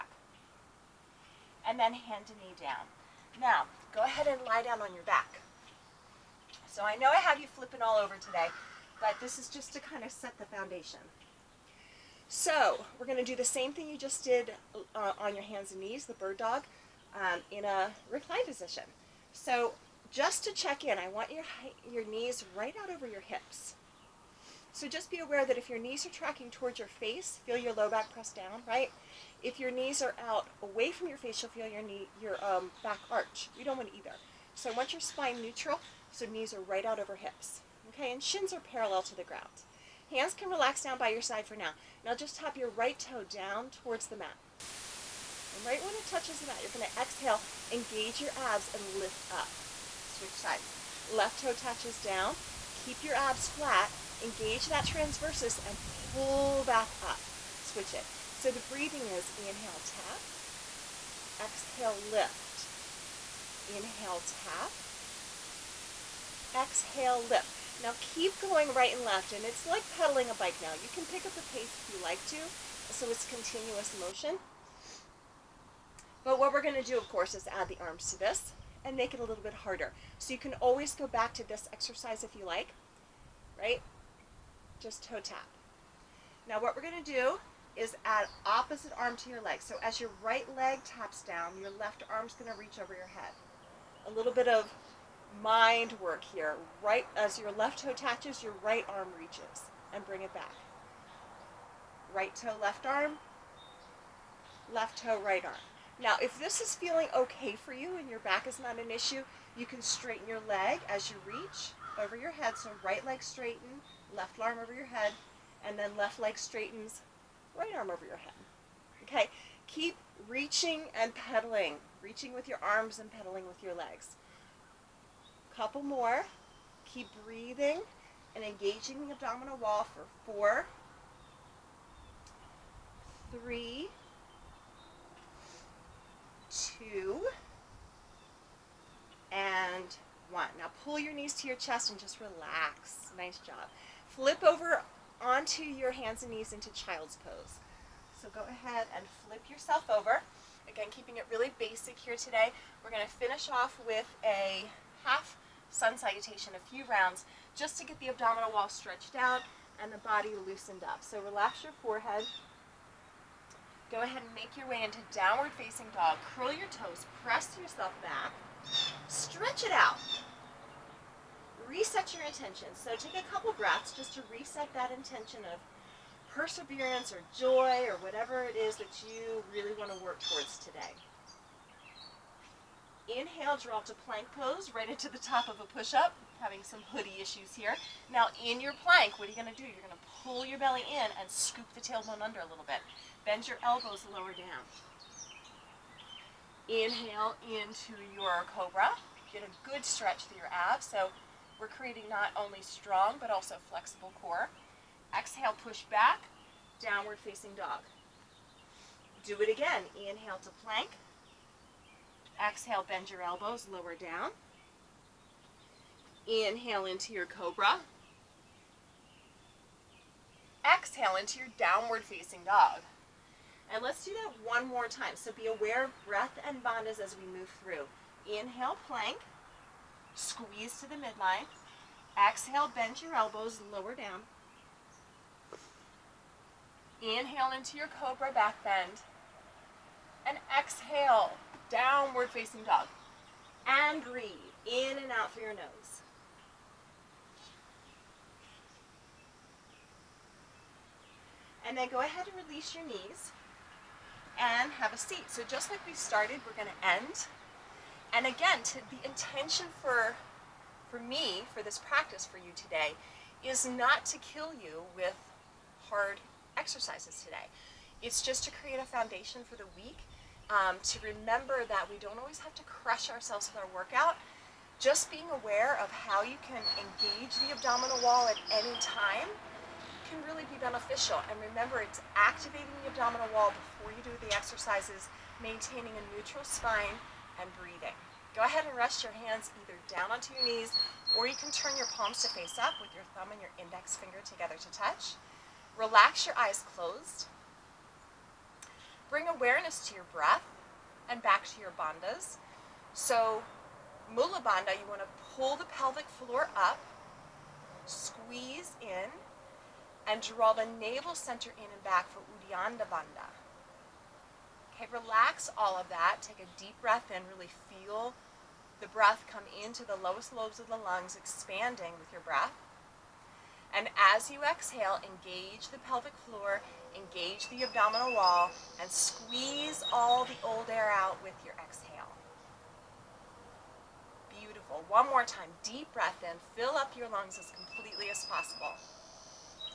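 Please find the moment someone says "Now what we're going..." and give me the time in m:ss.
1:26.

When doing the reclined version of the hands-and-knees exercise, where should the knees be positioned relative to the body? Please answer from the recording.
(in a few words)
Over your hips.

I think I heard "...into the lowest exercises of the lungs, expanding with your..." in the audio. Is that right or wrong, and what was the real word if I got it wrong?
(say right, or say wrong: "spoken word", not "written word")
wrong: "lobes", not "exercises".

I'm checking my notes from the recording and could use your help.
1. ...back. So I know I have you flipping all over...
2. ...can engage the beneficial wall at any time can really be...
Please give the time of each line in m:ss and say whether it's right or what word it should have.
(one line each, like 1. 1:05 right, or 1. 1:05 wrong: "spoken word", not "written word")
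1. 0:05 right
2. 4:36 wrong: "abdominal", not "beneficial".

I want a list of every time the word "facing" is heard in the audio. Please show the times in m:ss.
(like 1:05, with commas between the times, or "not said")
2:45, 3:27, 3:42, 4:02.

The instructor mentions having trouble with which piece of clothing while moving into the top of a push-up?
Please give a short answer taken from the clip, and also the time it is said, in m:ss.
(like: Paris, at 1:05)
Hoodie, at 3:06.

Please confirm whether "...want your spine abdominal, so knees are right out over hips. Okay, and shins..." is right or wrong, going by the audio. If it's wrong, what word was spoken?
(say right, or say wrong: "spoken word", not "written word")
wrong: "neutral", not "abdominal".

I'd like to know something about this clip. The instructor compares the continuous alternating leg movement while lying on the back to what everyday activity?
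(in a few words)
Pedaling a bike.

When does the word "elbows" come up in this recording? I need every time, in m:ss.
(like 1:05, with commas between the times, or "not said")
3:13, 3:33, 3:53.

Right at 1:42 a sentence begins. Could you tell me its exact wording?
Right toe, left arm, left toe, right arm.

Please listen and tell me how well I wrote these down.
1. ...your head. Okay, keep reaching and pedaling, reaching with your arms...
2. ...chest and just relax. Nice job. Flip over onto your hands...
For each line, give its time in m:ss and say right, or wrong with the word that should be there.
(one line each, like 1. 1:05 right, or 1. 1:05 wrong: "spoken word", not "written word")
1. 1:58 right
2. 2:21 right.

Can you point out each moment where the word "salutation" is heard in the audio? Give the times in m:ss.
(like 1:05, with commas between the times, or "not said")
2:35.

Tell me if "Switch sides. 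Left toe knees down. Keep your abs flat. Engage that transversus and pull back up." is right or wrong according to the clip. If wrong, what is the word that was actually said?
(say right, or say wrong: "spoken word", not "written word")
wrong: "touches", not "knees".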